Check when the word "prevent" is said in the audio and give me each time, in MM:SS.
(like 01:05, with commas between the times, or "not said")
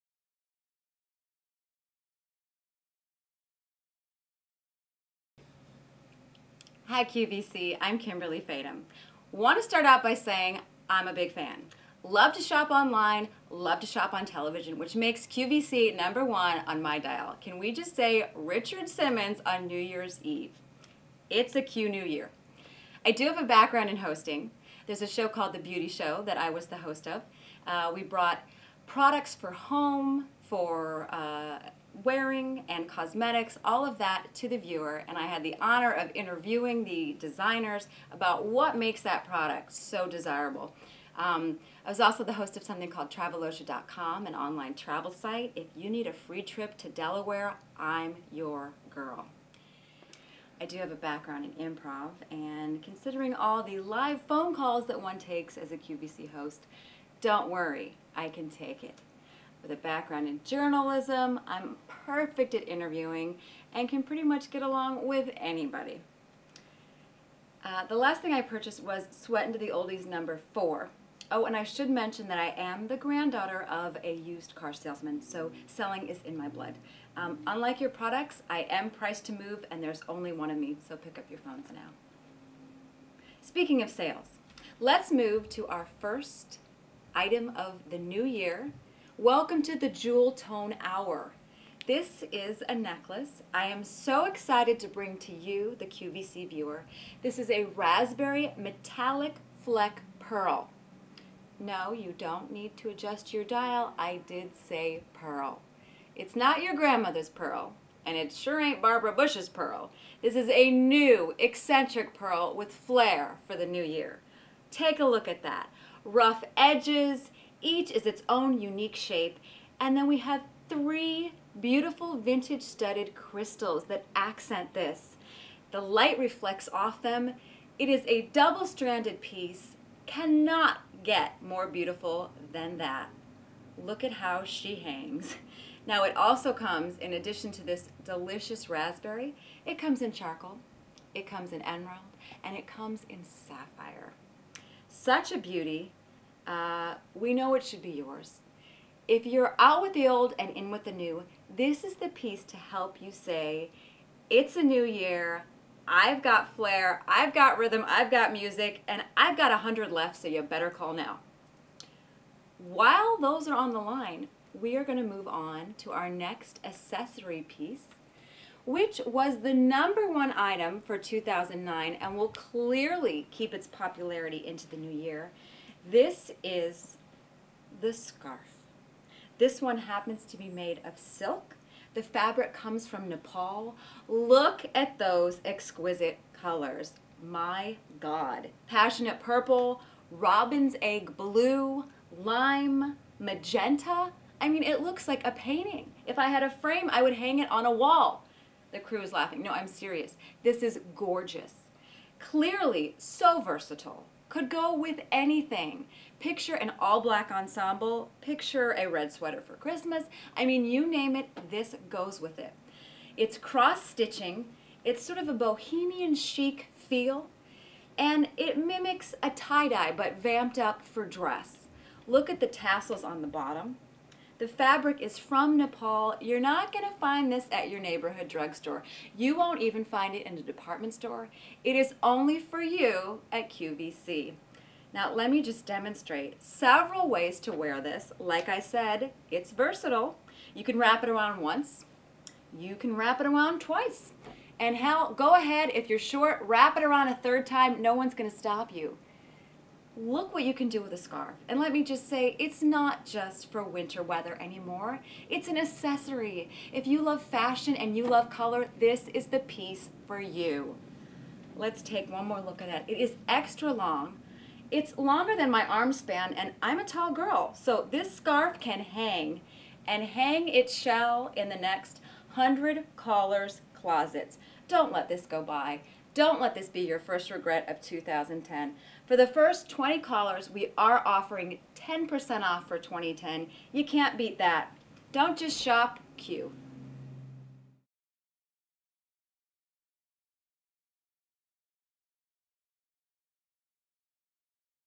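not said.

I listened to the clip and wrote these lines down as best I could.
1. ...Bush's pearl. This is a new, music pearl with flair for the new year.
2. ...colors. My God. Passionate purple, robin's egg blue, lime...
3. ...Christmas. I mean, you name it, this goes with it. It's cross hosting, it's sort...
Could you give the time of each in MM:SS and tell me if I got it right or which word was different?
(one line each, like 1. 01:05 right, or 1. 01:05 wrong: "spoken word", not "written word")
1. 01:49 wrong: "eccentric", not "music"
2. 03:06 right
3. 03:29 wrong: "stitching", not "hosting".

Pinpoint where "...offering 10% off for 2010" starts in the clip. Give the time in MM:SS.
04:41.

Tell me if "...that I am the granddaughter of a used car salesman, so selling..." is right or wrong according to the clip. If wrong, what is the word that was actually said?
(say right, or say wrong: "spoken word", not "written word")
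right.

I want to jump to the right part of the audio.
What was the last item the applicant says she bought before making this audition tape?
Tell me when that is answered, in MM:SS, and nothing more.
01:09.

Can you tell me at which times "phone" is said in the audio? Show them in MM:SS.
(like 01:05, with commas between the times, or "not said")
00:54, 01:21.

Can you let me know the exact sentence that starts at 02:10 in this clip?
Cannot get more beautiful than that.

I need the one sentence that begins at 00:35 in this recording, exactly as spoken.
And I had the honor of interviewing the designers about what makes that product so desirable.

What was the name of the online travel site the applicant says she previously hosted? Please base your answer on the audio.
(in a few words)
Travelosha.com.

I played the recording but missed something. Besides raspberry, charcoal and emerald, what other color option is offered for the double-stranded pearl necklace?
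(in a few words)
Sapphire.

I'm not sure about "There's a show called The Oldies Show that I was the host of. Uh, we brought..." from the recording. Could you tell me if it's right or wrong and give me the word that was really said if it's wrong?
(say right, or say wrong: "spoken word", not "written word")
wrong: "Beauty", not "Oldies".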